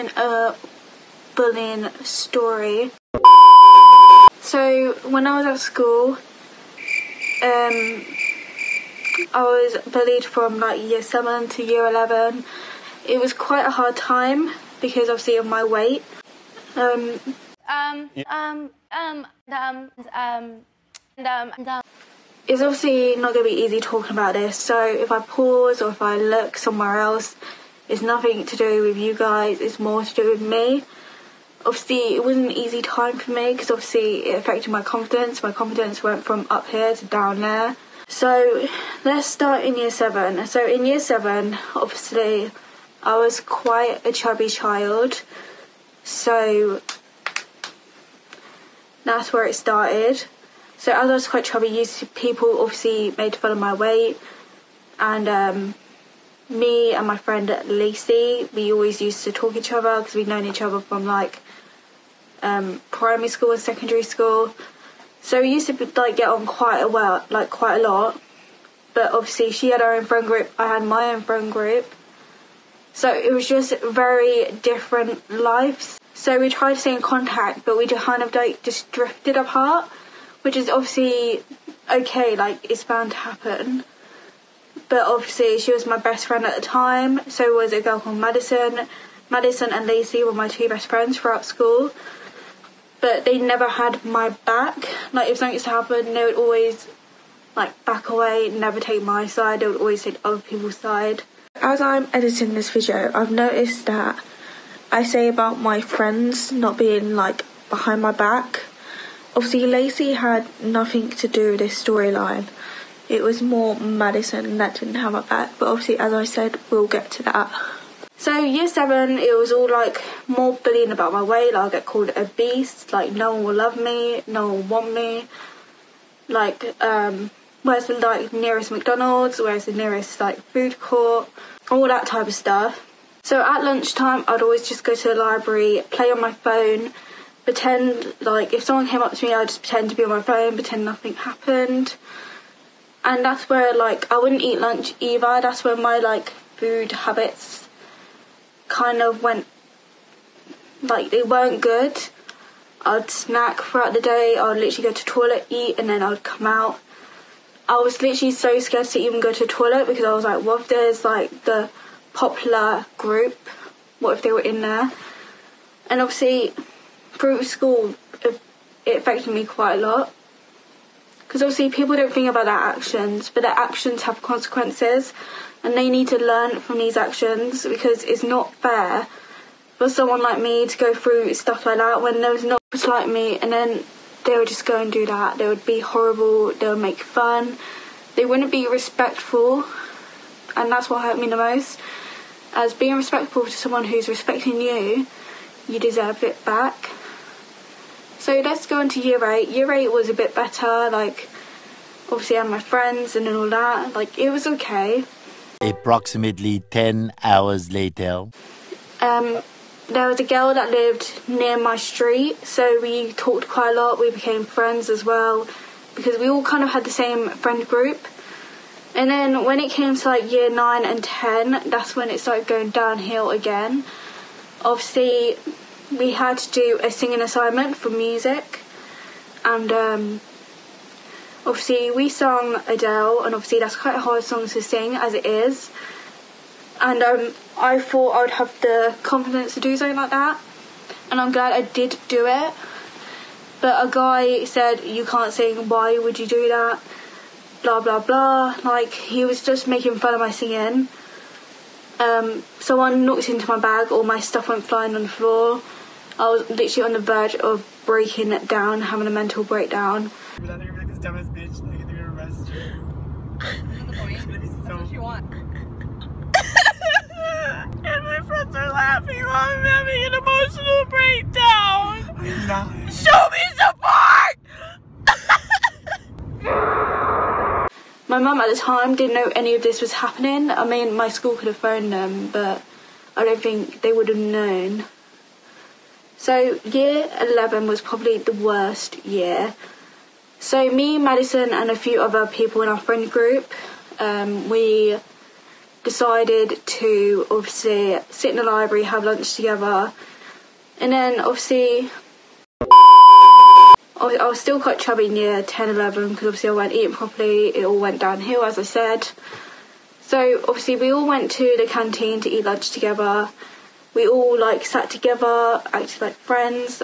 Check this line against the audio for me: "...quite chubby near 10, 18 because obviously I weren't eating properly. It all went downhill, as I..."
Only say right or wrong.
wrong.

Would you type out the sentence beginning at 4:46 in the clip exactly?
So, year 11 was probably the worst year.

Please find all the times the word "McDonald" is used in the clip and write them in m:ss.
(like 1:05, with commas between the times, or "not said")
2:08.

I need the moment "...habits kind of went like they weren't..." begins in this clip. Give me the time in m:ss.
2:26.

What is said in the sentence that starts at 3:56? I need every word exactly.
And um, I thought I would have the confidence to do something like that, and I'm glad I did do it.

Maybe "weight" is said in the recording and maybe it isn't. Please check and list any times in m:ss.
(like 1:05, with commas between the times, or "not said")
0:15, 0:53, 2:01.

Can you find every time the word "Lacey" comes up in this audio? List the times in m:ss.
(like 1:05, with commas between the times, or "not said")
0:57, 1:29, 1:49.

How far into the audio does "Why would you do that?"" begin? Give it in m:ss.
4:05.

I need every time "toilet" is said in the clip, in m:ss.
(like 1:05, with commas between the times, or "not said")
2:35, 2:39.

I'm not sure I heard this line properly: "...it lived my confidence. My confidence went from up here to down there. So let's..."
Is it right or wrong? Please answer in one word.
wrong.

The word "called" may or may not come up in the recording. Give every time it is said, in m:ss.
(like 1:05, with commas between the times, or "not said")
1:27, 2:01.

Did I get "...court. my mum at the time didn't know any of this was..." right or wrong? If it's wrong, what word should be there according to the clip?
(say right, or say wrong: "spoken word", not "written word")
wrong: "support", not "court".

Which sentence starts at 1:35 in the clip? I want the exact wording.
Like if something used to happen, they would always like back away, never take my side.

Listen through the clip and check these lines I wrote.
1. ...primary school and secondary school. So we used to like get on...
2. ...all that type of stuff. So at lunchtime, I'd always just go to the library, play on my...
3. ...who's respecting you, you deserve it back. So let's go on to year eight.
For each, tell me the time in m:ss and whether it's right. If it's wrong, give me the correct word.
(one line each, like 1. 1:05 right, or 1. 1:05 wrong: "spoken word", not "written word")
1. 1:02 right
2. 2:11 right
3. 3:13 right.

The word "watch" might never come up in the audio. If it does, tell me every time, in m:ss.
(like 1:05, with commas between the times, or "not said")
not said.